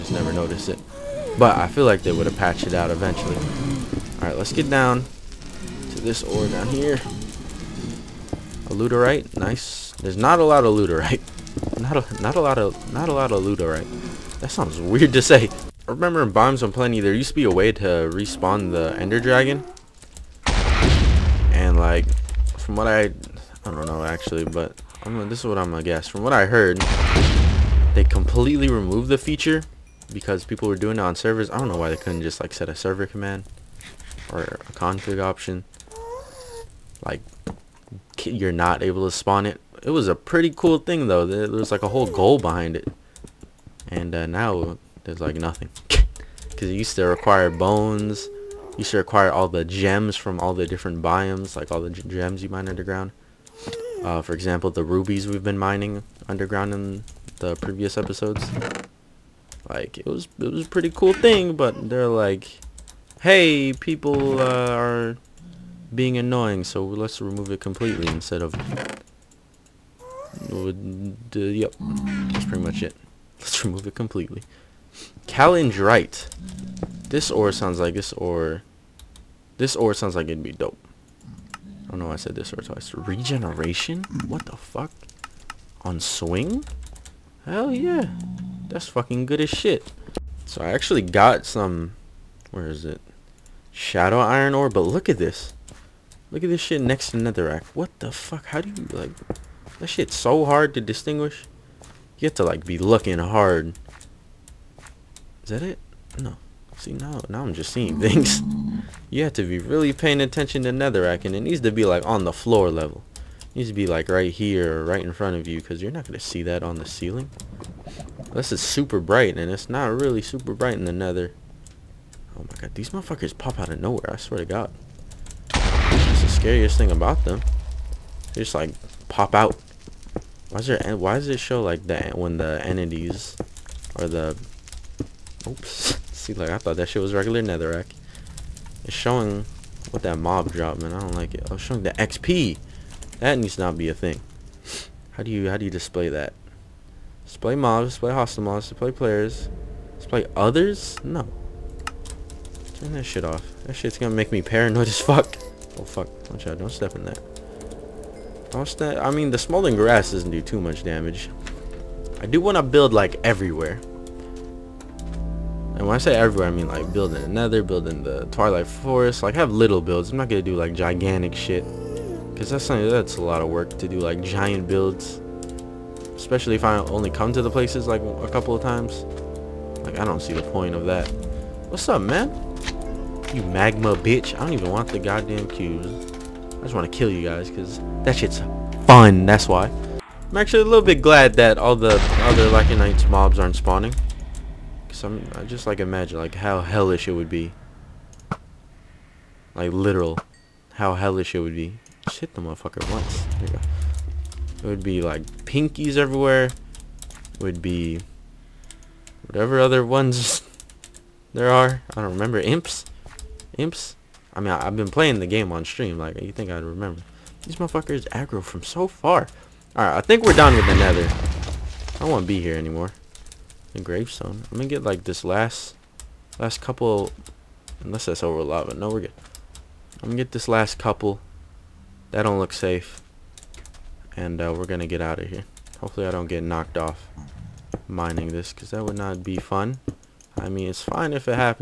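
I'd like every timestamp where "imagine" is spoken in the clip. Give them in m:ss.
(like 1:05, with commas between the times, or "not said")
3:15.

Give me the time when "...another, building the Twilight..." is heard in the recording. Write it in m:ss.
2:47.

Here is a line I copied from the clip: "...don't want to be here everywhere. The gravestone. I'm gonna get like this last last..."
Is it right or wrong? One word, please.
wrong.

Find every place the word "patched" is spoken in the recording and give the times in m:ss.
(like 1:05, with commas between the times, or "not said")
0:02.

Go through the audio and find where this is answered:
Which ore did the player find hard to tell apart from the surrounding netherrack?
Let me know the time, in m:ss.
1:33.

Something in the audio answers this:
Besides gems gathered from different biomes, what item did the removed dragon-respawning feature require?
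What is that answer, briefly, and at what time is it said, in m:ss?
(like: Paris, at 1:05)
bones, at 0:47.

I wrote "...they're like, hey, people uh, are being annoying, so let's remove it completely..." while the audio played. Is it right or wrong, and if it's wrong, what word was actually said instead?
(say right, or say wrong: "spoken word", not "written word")
right.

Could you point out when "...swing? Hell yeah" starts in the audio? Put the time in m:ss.
1:25.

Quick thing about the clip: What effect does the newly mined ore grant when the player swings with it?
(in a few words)
Regeneration.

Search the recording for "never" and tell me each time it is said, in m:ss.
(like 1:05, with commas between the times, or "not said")
0:00.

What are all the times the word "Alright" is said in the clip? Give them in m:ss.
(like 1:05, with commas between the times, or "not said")
0:04, 3:39.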